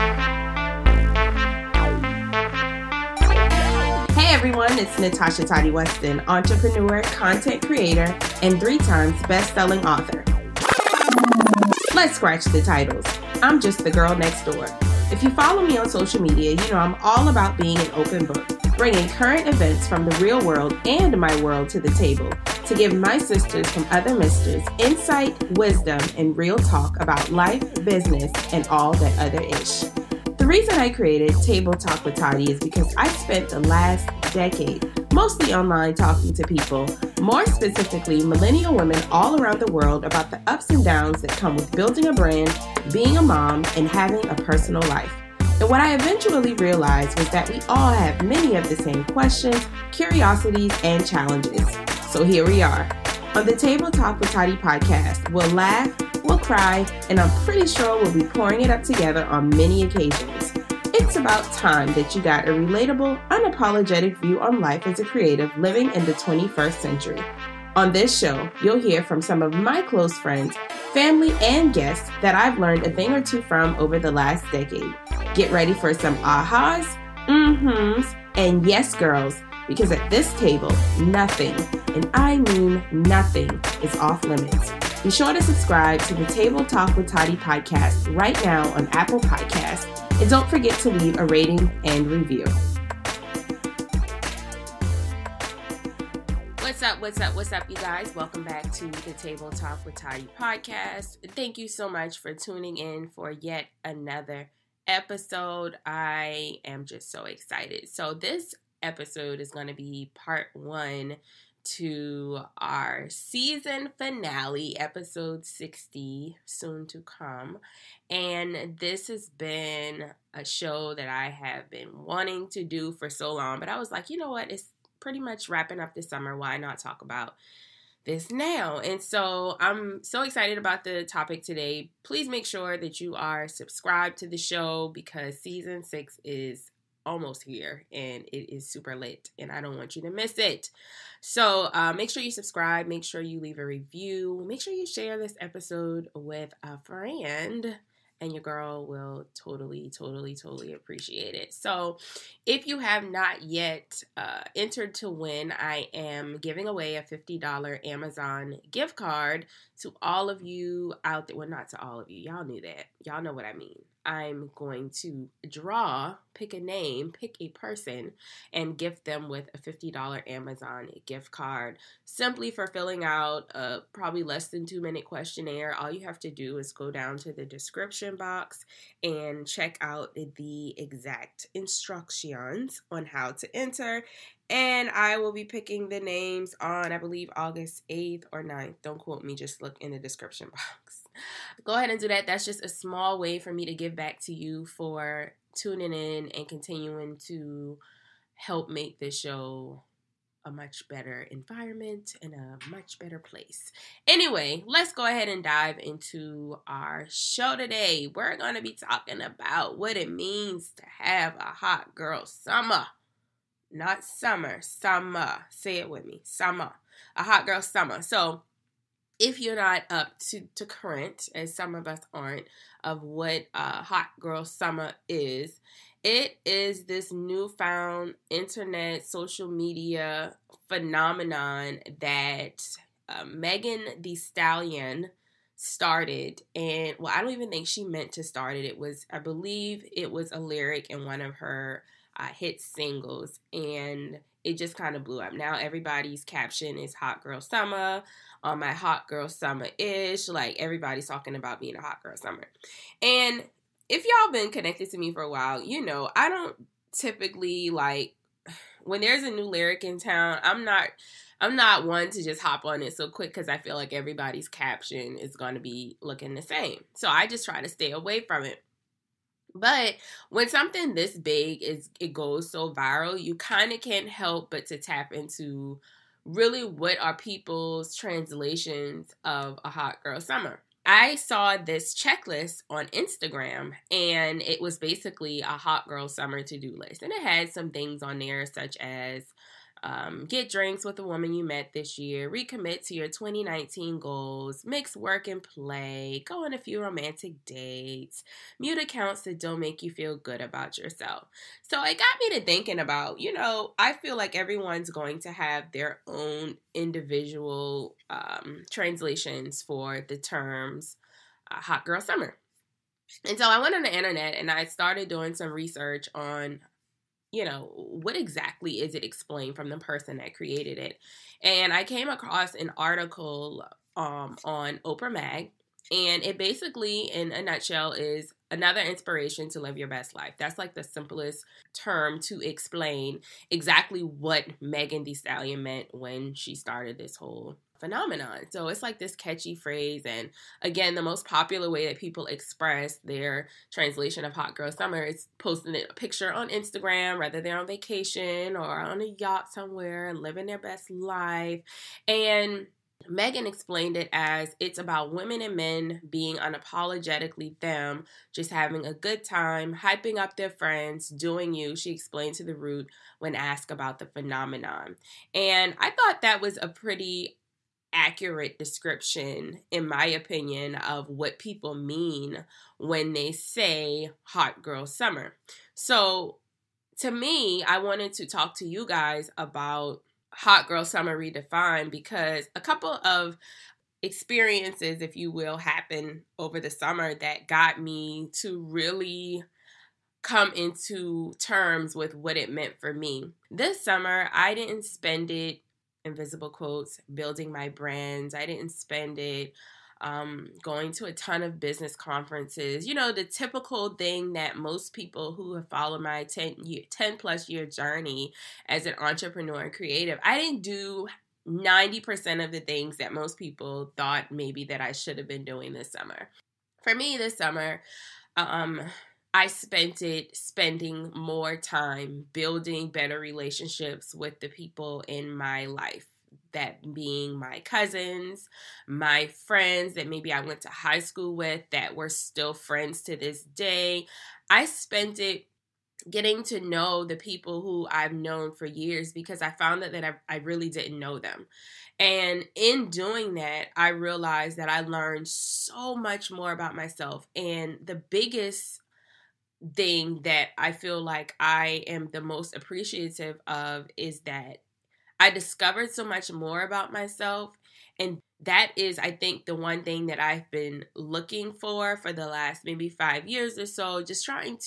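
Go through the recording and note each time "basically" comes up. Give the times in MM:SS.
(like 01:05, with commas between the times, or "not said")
04:44, 05:26.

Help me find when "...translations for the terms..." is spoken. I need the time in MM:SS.
05:08.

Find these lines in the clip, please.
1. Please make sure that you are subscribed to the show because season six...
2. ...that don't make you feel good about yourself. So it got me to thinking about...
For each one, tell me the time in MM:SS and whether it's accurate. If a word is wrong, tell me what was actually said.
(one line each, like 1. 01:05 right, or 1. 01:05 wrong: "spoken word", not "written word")
1. 02:12 right
2. 04:59 right.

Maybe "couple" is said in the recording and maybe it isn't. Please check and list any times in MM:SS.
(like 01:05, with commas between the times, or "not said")
06:22.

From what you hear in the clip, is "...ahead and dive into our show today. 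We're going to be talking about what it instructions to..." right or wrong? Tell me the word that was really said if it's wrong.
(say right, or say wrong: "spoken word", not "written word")
wrong: "means", not "instructions".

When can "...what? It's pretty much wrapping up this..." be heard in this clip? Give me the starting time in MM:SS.
02:04.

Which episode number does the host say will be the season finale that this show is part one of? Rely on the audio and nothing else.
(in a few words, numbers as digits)
60.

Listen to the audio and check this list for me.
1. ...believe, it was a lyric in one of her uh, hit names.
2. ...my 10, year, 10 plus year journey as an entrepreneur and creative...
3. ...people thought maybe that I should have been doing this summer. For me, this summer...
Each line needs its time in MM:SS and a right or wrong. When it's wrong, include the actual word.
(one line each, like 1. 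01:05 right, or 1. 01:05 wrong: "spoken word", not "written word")
1. 03:59 wrong: "singles", not "names"
2. 06:46 right
3. 06:53 right.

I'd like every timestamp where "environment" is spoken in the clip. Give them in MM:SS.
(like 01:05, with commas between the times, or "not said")
03:21.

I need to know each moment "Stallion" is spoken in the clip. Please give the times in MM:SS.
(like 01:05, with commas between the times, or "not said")
03:54, 05:35.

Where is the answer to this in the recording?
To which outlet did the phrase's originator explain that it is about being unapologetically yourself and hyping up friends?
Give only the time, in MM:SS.
06:02.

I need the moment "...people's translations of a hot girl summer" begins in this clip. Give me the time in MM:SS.
04:37.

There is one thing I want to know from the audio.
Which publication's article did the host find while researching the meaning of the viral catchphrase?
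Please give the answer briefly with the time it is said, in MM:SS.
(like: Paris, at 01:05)
Oprah Mag, at 05:24.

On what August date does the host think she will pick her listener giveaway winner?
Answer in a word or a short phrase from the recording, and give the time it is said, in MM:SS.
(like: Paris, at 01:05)
August 8th, at 03:07.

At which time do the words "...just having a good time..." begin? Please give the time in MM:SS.
05:58.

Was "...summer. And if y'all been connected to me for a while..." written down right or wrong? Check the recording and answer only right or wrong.
right.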